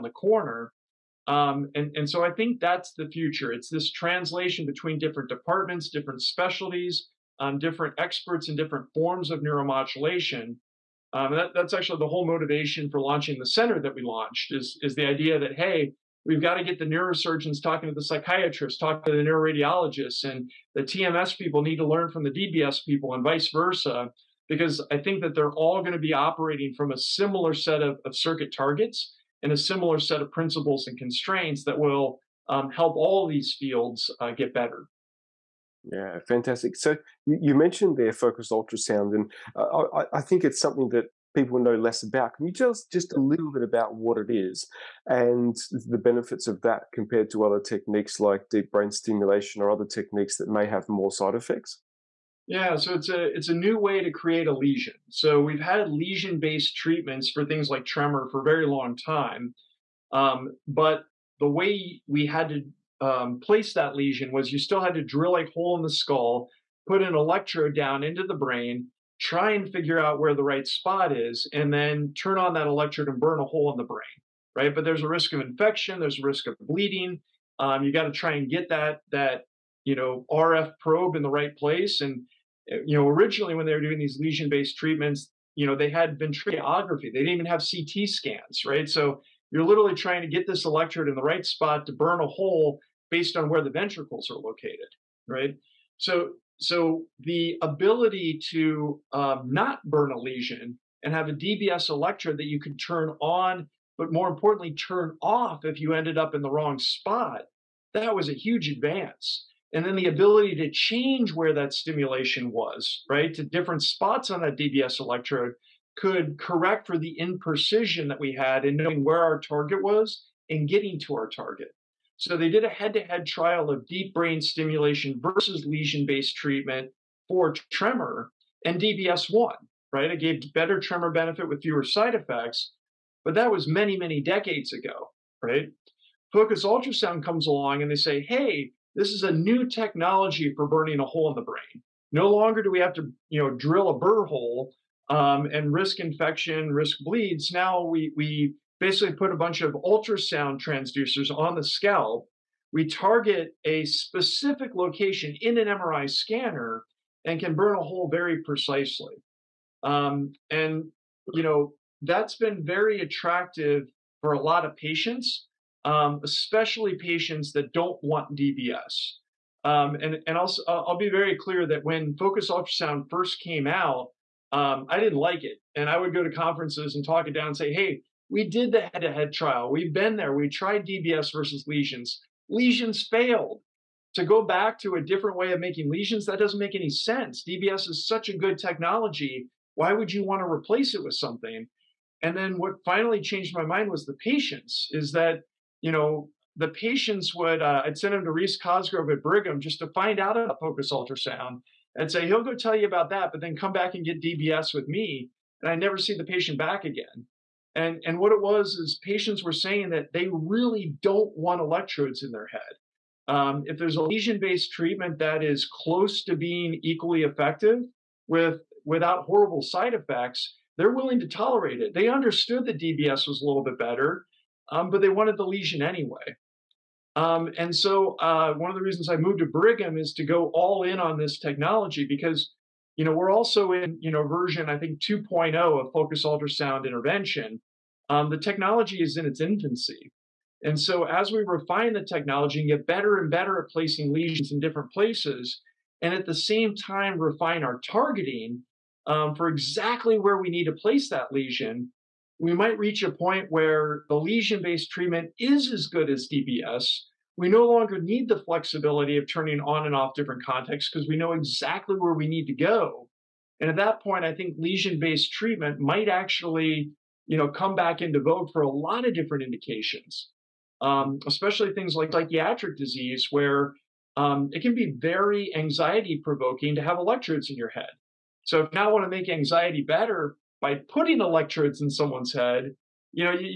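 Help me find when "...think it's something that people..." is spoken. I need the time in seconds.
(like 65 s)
40 s.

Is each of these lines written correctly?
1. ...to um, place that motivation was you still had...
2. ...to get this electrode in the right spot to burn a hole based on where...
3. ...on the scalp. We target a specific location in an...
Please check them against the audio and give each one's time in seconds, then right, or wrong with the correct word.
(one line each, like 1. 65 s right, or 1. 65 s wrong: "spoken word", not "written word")
1. 62 s wrong: "lesion", not "motivation"
2. 90 s right
3. 151 s right.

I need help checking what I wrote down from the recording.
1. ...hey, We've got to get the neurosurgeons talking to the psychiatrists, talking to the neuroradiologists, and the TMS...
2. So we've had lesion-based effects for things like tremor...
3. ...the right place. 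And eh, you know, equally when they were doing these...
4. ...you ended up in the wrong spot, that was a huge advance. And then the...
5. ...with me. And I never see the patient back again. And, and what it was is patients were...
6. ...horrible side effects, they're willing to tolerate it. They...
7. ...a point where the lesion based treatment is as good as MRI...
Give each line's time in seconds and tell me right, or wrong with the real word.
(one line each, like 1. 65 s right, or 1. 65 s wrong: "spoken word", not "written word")
1. 15 s right
2. 55 s wrong: "treatments", not "effects"
3. 81 s wrong: "originally", not "equally"
4. 105 s right
5. 204 s right
6. 219 s right
7. 253 s wrong: "DBS", not "MRI".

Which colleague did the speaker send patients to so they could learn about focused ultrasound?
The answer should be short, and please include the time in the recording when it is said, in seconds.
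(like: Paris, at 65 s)
Rees Cosgrove, at 198 s.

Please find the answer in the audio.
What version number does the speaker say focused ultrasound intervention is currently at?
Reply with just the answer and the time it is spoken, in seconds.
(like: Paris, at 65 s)
2.0, at 234 s.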